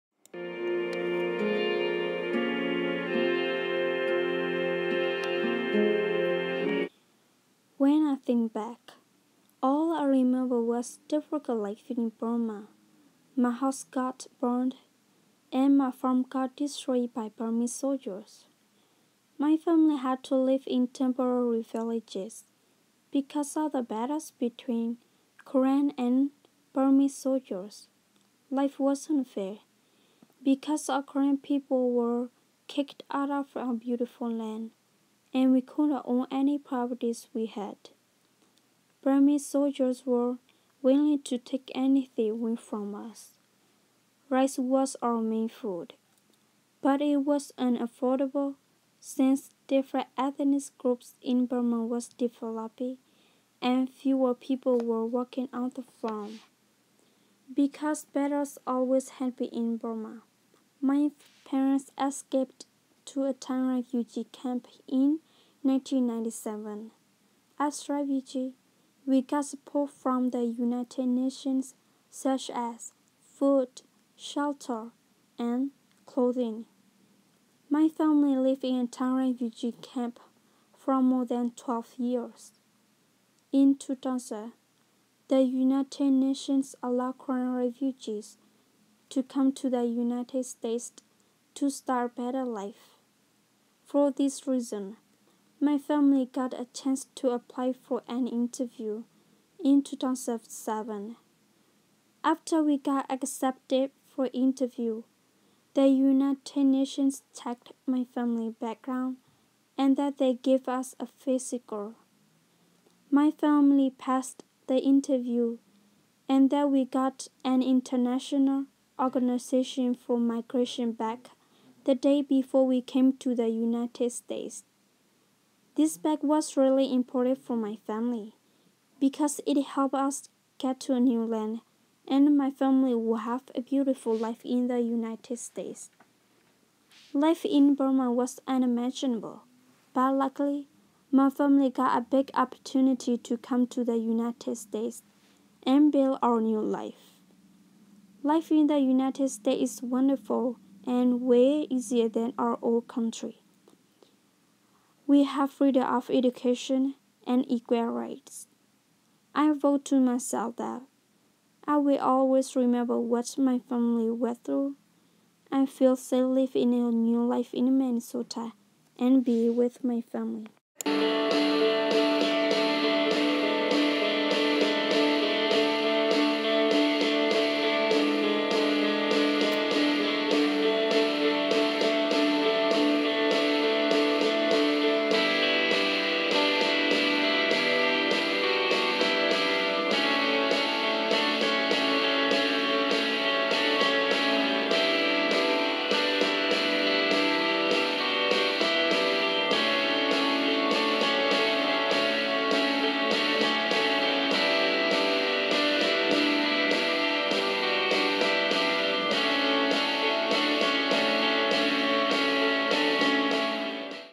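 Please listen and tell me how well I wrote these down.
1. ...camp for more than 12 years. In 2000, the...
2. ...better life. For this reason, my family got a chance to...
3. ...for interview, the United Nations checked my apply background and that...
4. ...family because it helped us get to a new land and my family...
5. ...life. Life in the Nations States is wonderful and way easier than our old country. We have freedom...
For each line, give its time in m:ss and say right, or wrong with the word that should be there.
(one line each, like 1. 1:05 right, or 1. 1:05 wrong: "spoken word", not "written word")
1. 1:19 right
2. 1:32 right
3. 1:44 wrong: "family", not "apply"
4. 2:07 right
5. 2:26 wrong: "United", not "Nations".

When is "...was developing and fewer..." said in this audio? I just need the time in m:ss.
0:51.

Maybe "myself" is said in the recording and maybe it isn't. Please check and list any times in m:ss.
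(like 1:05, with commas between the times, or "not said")
2:39.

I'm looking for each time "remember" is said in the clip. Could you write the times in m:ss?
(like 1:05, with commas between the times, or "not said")
0:10, 2:42.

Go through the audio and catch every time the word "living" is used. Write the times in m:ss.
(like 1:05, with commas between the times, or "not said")
2:46.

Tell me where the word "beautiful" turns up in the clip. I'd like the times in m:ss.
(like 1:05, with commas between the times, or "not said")
0:33, 2:13.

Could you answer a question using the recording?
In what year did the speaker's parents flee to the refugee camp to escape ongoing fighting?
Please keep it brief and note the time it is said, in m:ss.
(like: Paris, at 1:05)
1997, at 1:05.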